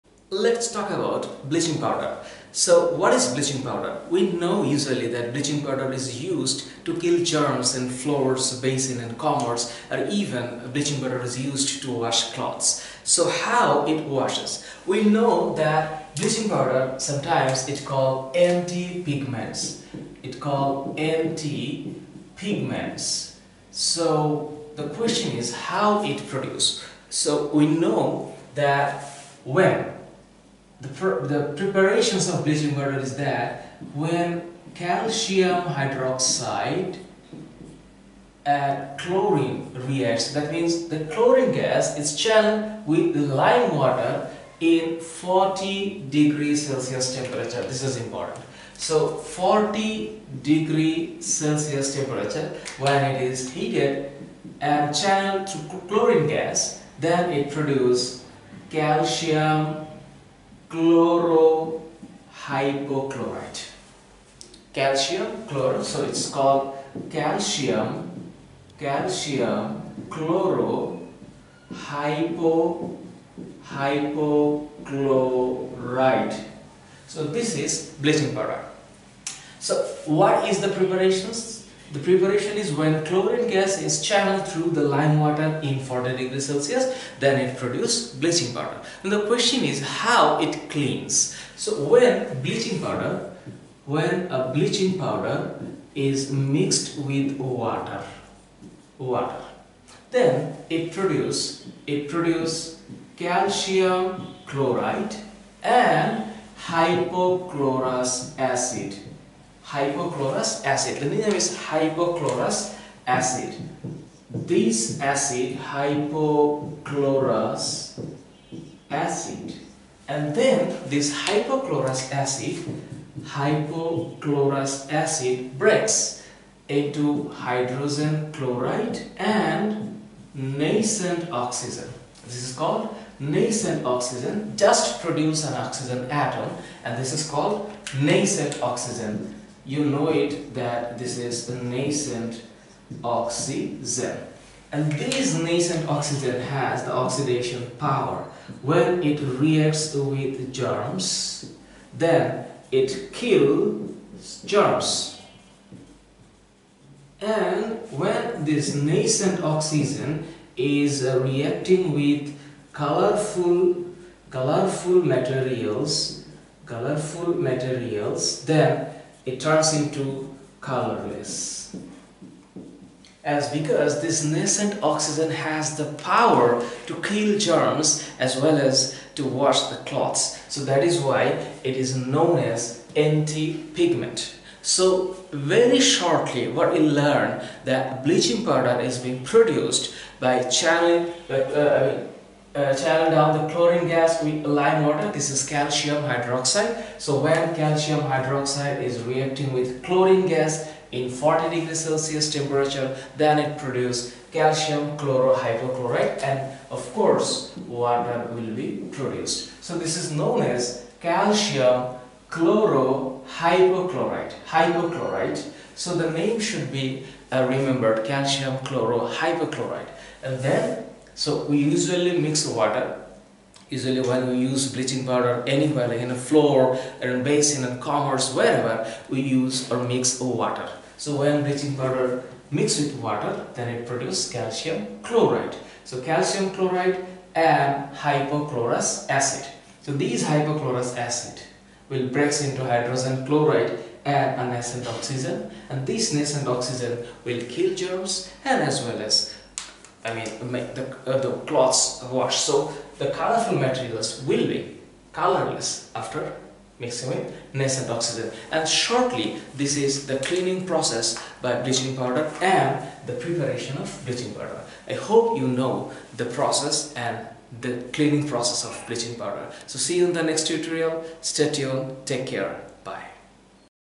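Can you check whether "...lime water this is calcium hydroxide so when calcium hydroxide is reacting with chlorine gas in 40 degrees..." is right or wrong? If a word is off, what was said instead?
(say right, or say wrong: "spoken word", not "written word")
right.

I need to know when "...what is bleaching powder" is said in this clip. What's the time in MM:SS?
00:02.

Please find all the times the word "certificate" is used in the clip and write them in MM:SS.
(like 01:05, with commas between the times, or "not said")
not said.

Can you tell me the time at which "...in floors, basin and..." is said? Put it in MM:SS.
00:07.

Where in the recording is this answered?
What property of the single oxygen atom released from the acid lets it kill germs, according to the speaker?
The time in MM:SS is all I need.
02:26.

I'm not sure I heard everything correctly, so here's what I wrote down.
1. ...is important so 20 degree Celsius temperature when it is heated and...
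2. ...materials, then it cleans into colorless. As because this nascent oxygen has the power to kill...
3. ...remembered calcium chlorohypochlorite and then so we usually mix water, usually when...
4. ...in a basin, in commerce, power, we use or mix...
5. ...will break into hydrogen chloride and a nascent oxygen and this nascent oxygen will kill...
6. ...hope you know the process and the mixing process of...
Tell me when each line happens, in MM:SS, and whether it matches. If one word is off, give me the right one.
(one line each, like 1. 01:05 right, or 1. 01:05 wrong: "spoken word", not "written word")
1. 00:47 wrong: "40", not "20"
2. 02:47 wrong: "turns", not "cleans"
3. 03:37 right
4. 03:47 wrong: "wherever", not "power"
5. 04:01 right
6. 04:24 wrong: "cleaning", not "mixing".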